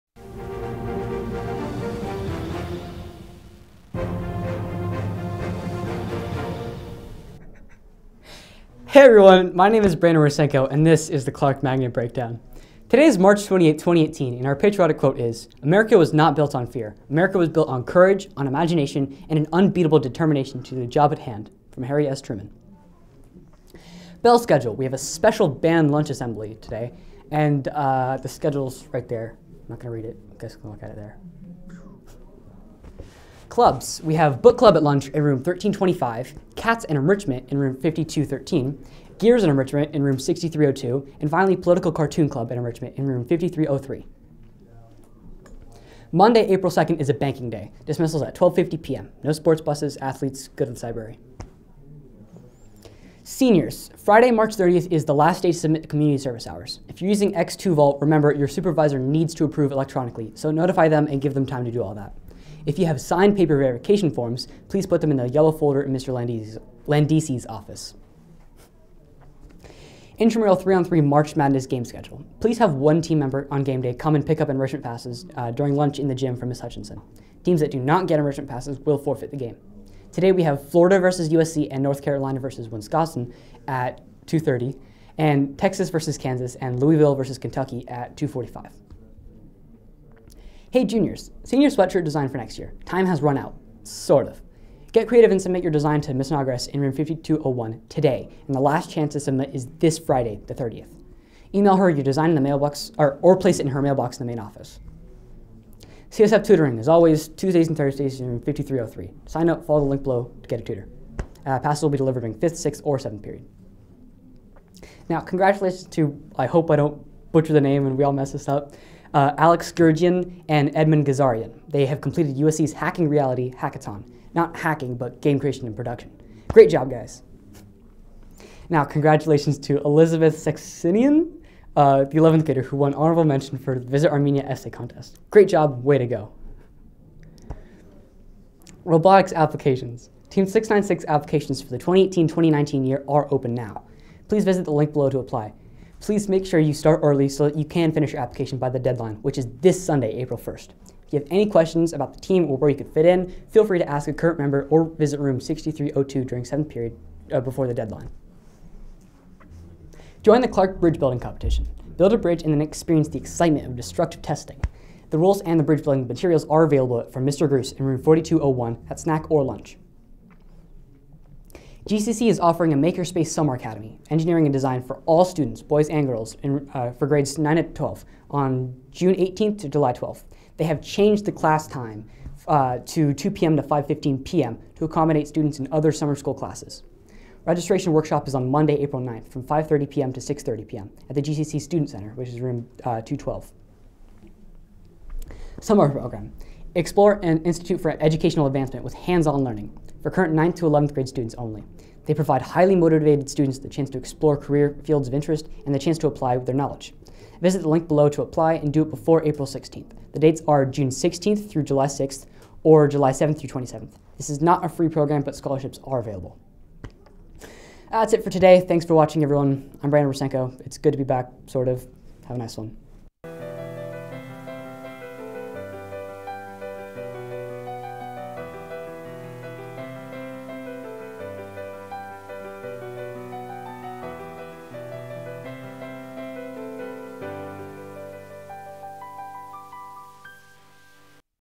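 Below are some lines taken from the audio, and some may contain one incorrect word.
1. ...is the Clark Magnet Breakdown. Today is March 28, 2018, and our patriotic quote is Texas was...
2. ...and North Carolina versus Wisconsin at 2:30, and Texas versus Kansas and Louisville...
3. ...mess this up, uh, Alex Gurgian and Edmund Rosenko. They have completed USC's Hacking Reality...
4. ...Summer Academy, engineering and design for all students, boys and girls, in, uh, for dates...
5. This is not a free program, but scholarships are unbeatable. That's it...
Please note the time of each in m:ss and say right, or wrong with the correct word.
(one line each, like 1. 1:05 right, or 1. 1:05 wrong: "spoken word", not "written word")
1. 0:11 wrong: "America", not "Texas"
2. 1:21 right
3. 1:58 wrong: "Gazarian", not "Rosenko"
4. 2:53 wrong: "grades", not "dates"
5. 3:34 wrong: "available", not "unbeatable".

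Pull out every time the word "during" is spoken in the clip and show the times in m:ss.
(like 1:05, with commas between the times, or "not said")
1:15, 1:52, 2:36.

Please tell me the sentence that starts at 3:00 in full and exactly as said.
They have changed the class time uh, to 2 p.m.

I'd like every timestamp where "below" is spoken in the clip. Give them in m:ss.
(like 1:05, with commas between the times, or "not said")
1:50, 2:24, 3:27.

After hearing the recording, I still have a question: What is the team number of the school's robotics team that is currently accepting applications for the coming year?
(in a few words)
696.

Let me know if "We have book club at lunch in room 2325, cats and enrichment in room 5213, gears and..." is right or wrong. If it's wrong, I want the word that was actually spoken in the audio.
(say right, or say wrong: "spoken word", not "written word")
wrong: "1325", not "2325".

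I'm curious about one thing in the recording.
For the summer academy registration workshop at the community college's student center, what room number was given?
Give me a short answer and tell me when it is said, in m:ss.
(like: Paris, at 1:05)
212, at 3:13.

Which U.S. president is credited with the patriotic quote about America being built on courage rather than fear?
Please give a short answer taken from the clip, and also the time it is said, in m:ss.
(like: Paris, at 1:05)
Harry S. Truman, at 0:21.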